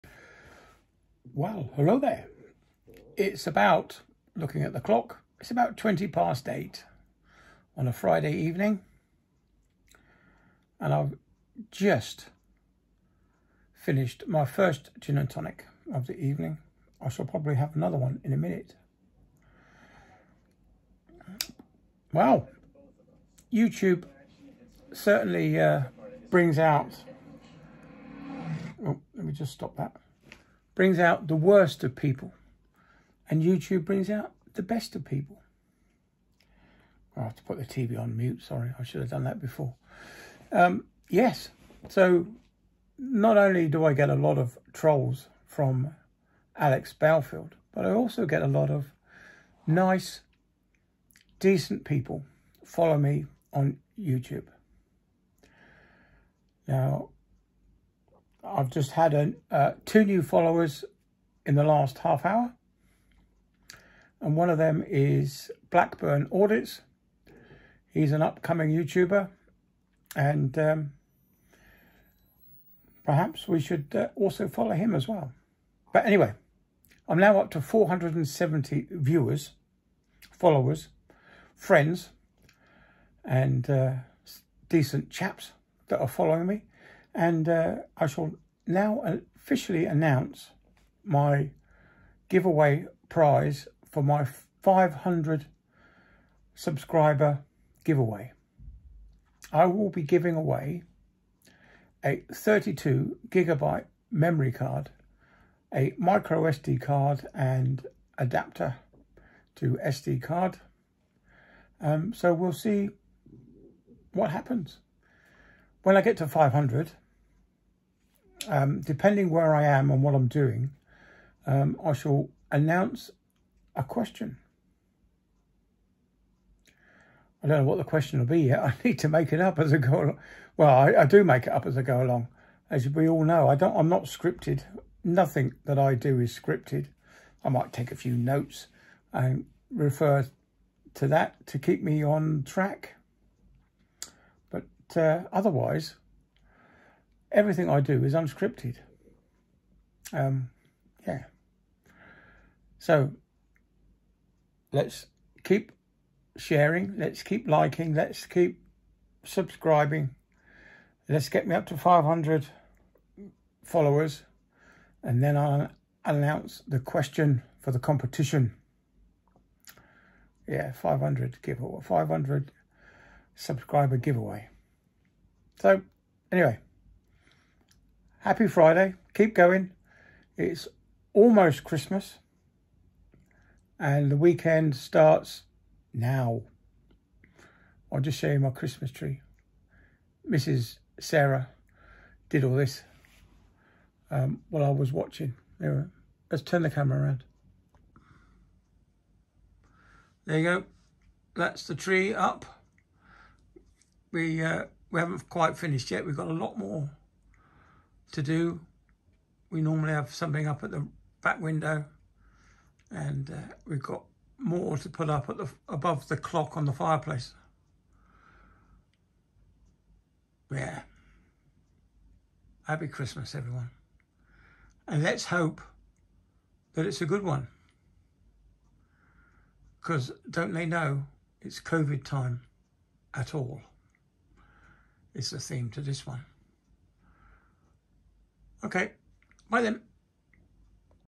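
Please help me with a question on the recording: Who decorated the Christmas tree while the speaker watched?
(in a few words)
Mrs. Sarah.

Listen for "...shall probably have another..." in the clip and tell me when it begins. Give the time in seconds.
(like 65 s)
17 s.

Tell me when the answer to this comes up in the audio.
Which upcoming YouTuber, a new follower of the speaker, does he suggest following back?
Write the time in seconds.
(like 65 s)
65 s.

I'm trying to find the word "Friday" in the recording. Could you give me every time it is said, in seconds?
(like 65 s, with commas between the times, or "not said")
7 s, 178 s.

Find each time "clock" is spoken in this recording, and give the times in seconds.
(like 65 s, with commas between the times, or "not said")
4 s, 216 s.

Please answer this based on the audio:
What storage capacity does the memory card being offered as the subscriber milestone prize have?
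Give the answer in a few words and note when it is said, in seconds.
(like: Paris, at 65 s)
32 gigabytes, at 102 s.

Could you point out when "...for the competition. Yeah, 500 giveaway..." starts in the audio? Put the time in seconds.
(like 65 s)
167 s.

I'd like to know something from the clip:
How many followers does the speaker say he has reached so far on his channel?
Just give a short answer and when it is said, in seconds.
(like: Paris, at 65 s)
470, at 77 s.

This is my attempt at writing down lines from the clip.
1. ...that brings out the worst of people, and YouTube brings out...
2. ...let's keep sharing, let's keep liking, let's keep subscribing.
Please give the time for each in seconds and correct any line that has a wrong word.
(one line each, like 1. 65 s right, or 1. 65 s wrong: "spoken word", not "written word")
1. 29 s right
2. 154 s right.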